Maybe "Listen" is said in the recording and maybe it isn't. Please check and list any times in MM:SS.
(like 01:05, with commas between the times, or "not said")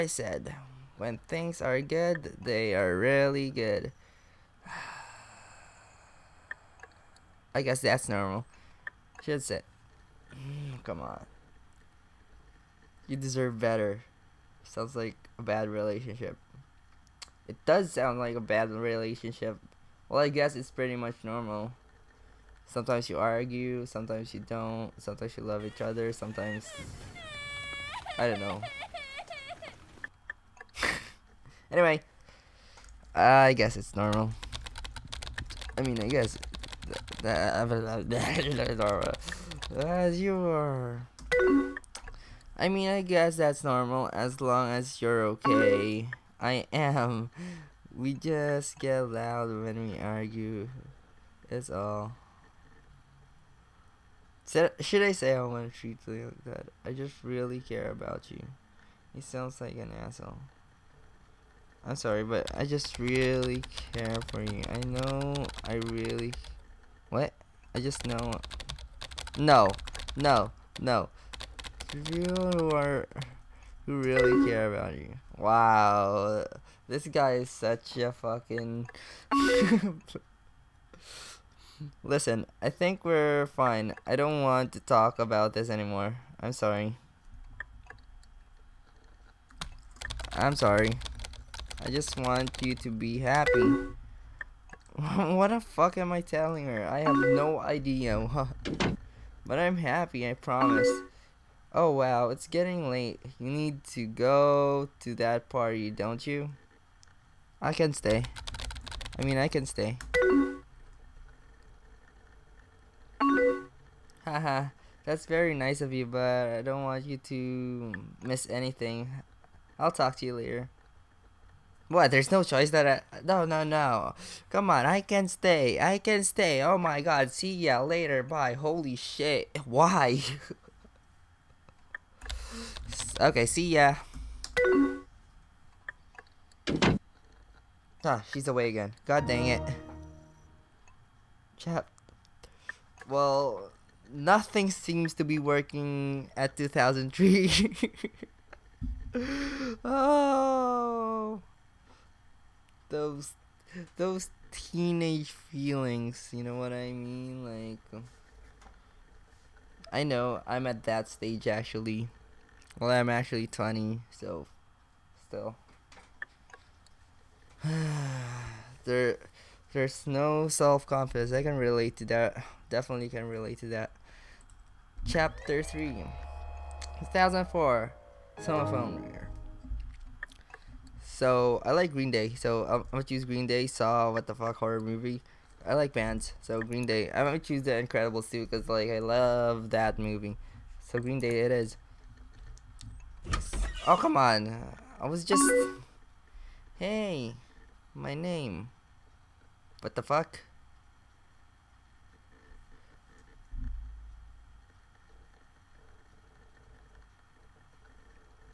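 01:22.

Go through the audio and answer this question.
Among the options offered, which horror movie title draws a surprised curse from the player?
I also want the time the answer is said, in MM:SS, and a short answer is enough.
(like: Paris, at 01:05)
Saw, at 03:03.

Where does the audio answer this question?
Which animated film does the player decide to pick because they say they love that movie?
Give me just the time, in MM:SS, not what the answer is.
03:07.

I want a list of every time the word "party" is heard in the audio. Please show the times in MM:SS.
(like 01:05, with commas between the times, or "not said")
01:45.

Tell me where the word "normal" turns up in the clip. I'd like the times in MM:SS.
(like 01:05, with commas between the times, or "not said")
00:08, 00:21, 00:33, 00:38, 00:43.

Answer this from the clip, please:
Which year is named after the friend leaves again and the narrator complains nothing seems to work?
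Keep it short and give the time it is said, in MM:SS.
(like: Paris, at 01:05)
2003, at 02:26.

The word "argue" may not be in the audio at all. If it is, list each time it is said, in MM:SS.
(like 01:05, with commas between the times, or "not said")
00:23, 00:49.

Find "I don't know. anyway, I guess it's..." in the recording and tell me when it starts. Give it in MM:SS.
00:28.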